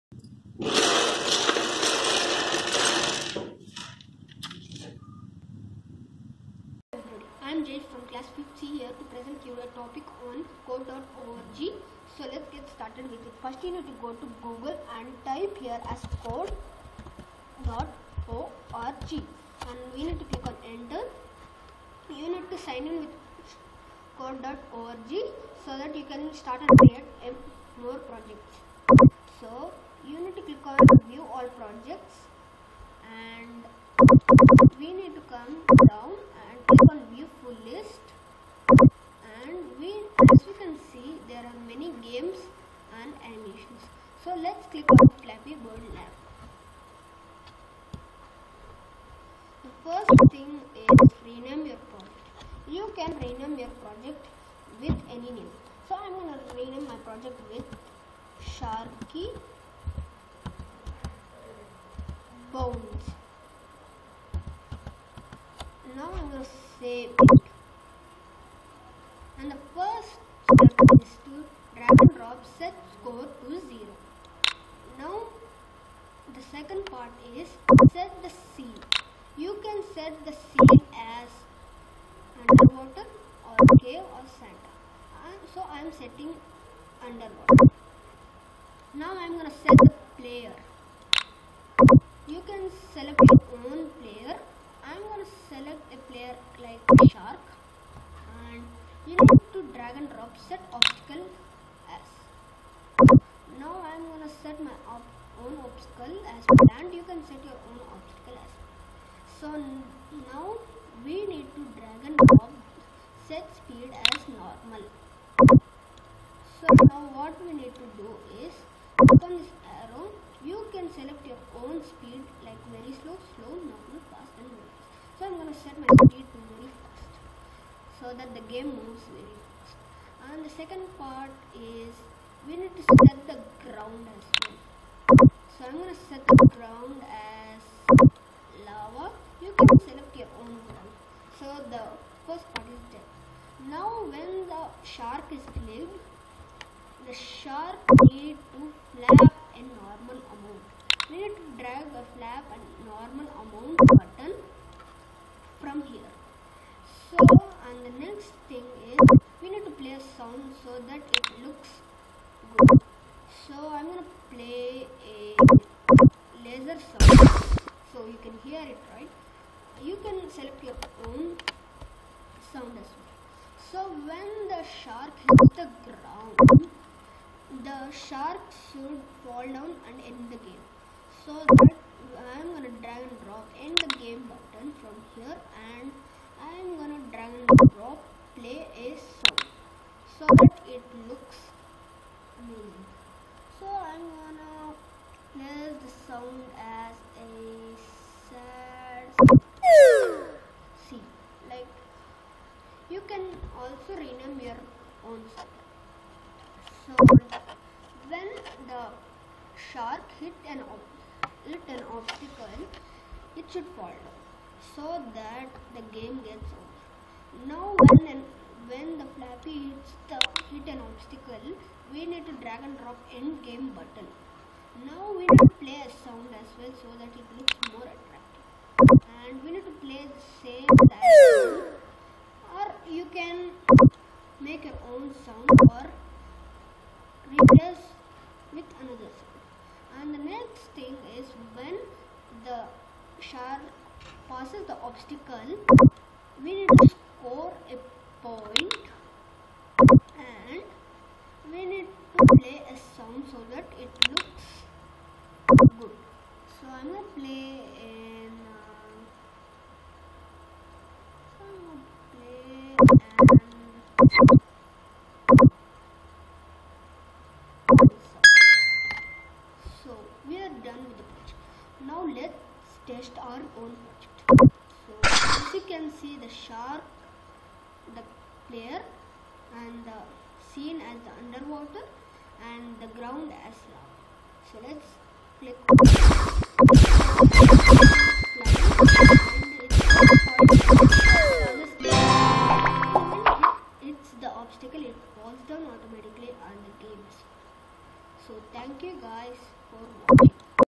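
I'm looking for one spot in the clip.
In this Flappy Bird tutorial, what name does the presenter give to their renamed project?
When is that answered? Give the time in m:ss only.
0:58.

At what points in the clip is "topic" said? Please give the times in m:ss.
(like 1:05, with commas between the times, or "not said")
0:09.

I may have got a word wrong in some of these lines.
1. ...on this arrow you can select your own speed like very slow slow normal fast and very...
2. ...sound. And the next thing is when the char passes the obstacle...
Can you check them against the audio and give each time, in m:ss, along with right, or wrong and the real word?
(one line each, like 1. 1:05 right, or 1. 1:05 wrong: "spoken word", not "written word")
1. 1:59 right
2. 3:59 right.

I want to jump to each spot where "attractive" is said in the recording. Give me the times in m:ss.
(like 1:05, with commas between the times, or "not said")
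3:47.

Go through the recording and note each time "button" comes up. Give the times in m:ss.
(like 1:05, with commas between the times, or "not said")
2:33, 3:04, 3:43.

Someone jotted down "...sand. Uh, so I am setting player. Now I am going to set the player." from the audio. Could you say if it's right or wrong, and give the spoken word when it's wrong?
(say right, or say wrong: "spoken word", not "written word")
wrong: "underwater", not "player".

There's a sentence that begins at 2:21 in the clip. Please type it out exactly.
So the first part is done.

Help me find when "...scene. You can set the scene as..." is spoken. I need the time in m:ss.
1:18.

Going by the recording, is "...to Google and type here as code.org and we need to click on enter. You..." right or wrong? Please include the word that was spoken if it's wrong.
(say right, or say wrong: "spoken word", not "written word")
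right.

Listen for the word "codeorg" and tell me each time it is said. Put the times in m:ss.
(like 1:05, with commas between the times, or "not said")
0:10, 0:16, 0:24.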